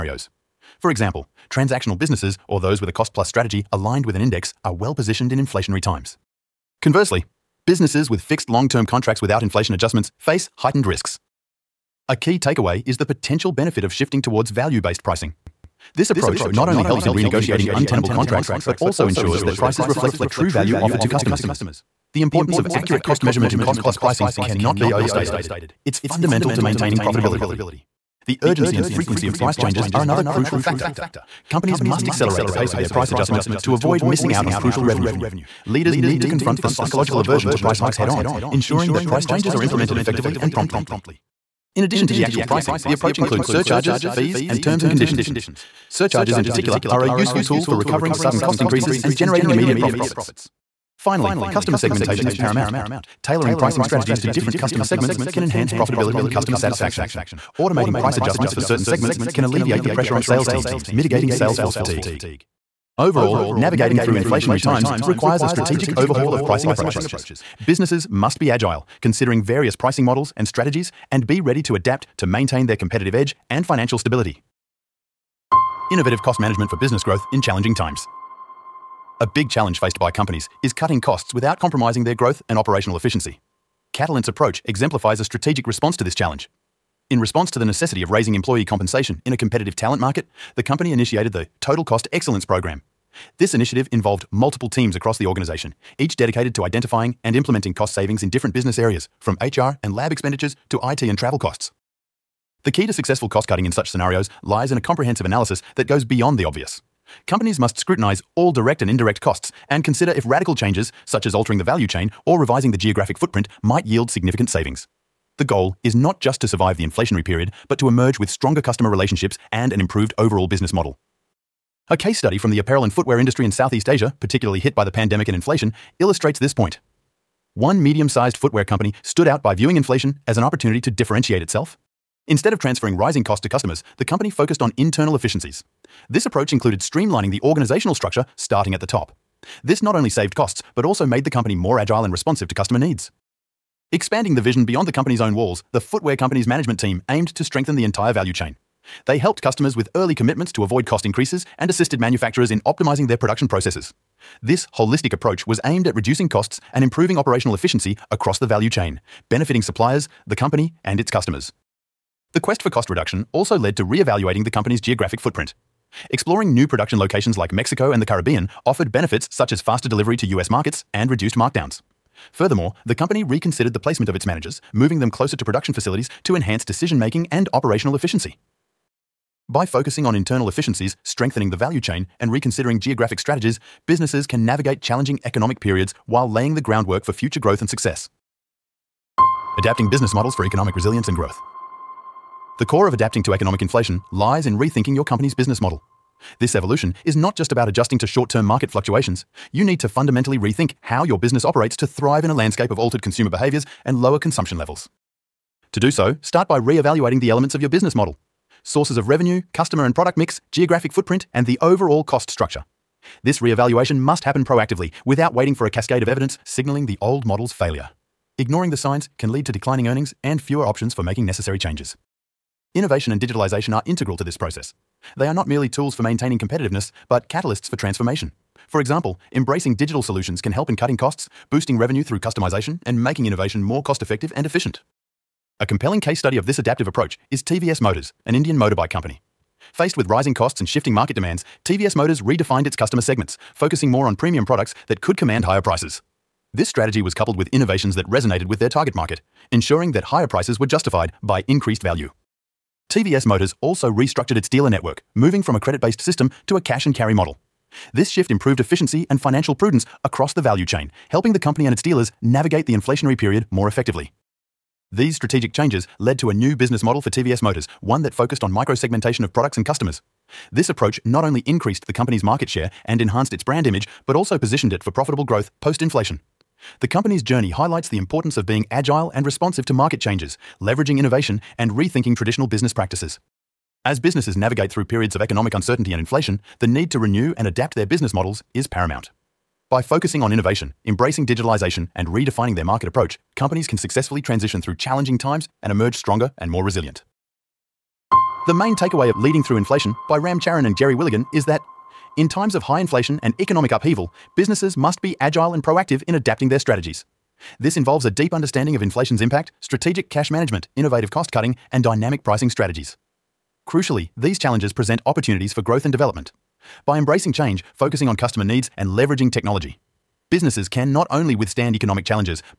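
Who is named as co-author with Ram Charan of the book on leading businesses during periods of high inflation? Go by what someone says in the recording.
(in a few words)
Geri Willigan.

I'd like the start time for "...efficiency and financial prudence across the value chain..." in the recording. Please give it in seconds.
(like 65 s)
258 s.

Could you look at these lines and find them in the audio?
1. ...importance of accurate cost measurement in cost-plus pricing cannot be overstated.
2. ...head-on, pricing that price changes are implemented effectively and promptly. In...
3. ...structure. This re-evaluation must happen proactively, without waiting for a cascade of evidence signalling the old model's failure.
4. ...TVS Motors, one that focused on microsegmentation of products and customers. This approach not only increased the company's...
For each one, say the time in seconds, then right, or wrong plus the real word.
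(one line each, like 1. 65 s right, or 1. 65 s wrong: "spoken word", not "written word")
1. 22 s right
2. 37 s wrong: "ensuring", not "pricing"
3. 212 s right
4. 267 s right.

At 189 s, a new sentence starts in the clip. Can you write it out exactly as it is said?
Adapting business models for economic resilience and growth.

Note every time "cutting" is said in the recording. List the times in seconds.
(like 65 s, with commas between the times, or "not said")
80 s, 103 s, 230 s, 311 s.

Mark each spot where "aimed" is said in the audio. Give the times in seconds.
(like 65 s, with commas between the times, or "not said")
147 s, 155 s.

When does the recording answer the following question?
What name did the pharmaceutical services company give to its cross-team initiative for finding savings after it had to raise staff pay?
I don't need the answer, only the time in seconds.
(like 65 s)
91 s.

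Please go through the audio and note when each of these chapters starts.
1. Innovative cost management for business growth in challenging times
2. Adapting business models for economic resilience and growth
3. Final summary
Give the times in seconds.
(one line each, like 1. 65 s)
1. 74 s
2. 188 s
3. 297 s.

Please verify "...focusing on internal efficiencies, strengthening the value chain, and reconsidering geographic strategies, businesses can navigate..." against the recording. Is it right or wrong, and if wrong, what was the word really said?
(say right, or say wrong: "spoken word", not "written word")
right.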